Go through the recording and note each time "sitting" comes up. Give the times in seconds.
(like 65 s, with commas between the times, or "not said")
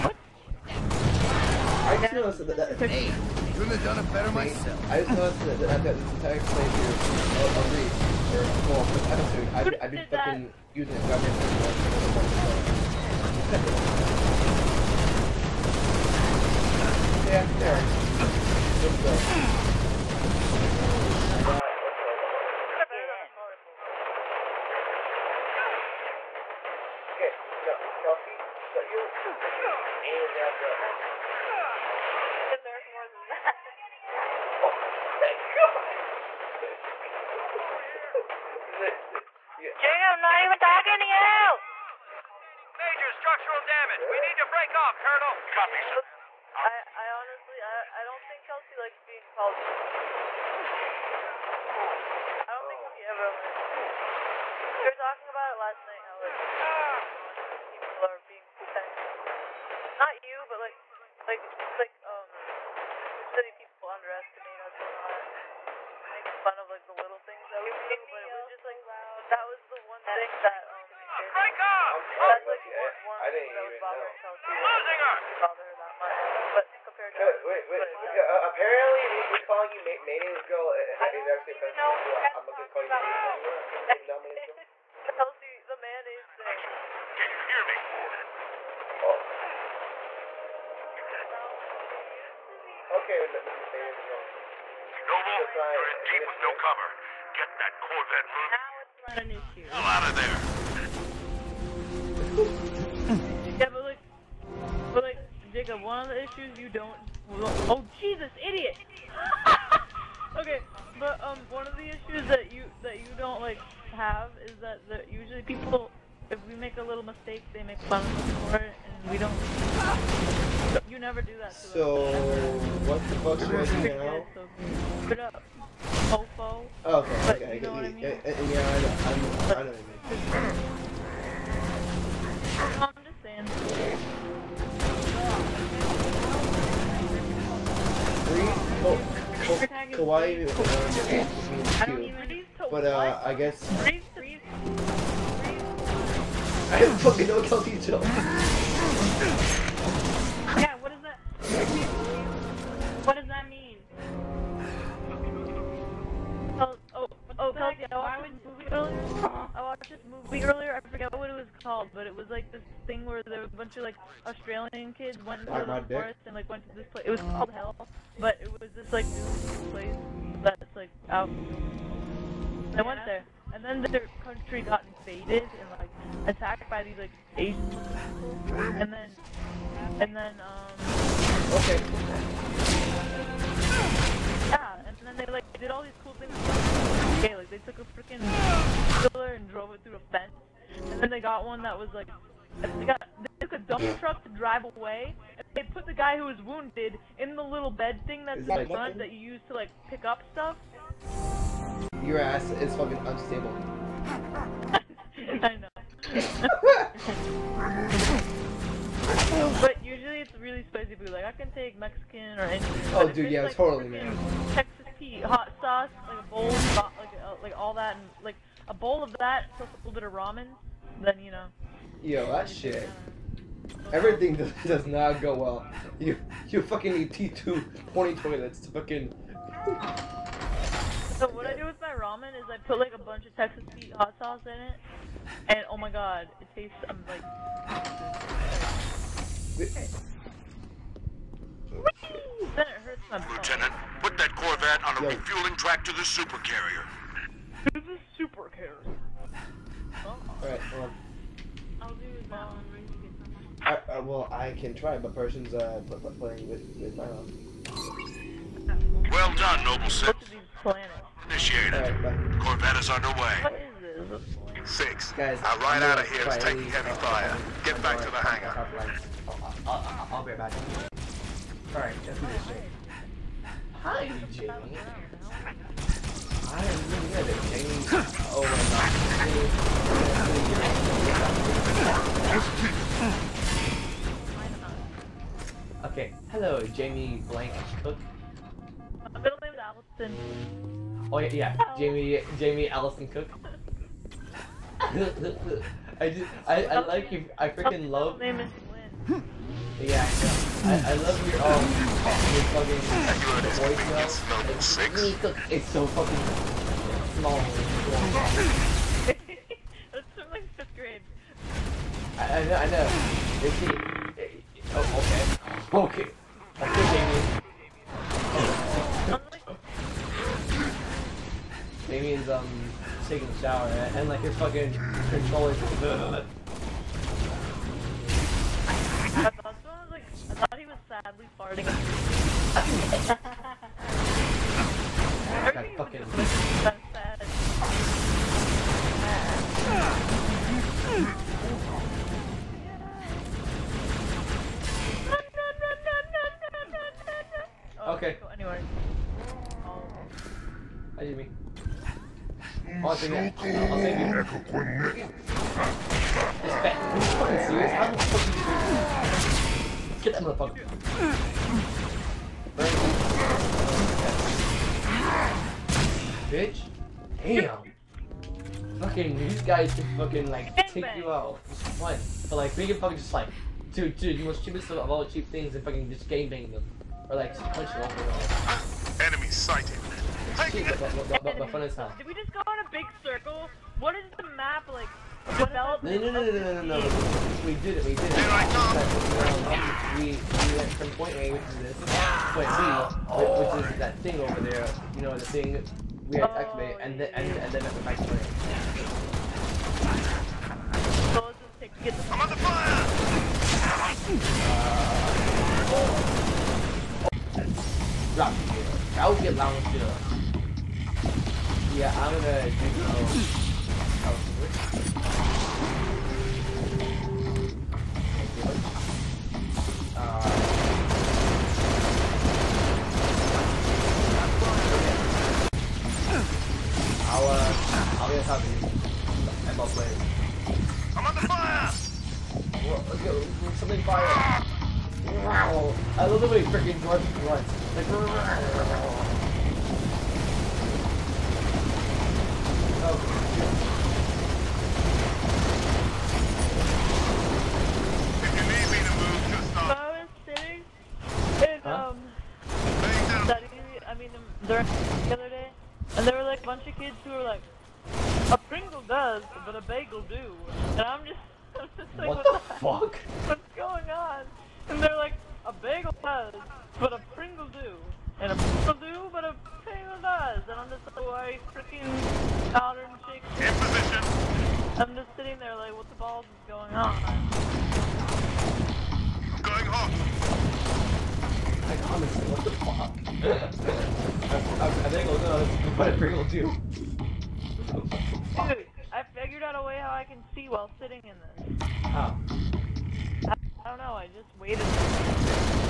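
475 s, 490 s.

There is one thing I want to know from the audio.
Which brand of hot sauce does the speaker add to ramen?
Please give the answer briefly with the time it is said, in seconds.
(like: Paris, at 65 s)
Texas Pete, at 233 s.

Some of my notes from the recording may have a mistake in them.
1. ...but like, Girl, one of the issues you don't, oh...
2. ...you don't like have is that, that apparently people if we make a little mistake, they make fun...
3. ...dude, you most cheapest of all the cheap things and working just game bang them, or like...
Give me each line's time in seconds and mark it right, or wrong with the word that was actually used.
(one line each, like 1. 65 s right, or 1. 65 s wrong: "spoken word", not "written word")
1. 104 s wrong: "Jacob", not "Girl"
2. 112 s wrong: "usually", not "apparently"
3. 373 s wrong: "fucking", not "working".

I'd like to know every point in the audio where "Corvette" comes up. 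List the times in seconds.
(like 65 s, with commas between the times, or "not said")
97 s, 244 s, 262 s.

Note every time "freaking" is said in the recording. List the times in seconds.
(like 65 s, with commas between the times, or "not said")
187 s, 297 s, 436 s, 471 s.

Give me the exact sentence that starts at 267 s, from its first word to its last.
I'll, Get back to the hangar.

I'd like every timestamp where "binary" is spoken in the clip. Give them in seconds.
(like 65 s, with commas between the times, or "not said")
not said.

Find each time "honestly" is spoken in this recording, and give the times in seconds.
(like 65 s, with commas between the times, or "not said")
47 s, 481 s.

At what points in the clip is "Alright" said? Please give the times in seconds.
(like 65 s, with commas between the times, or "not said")
250 s, 271 s.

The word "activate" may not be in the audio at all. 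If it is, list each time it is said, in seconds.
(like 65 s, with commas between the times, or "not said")
396 s.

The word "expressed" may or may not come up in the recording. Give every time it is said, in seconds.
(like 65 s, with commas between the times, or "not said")
not said.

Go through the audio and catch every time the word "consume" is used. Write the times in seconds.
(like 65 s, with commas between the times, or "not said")
not said.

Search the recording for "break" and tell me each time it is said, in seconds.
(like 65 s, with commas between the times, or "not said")
44 s, 71 s.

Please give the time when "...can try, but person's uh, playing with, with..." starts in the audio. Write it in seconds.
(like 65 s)
254 s.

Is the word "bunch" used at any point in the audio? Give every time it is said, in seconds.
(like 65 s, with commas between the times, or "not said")
163 s, 232 s, 456 s.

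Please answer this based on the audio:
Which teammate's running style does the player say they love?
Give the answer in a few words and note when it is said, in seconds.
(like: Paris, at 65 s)
George, at 436 s.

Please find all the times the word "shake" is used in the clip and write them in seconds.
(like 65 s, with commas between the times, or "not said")
473 s.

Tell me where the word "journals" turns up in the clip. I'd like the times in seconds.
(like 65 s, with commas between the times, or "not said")
not said.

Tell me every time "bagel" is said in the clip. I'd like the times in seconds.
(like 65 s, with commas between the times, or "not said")
459 s, 465 s.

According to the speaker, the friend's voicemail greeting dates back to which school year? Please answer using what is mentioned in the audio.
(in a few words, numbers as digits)
Fifth grade.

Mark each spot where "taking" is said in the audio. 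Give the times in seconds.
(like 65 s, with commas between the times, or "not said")
266 s, 323 s.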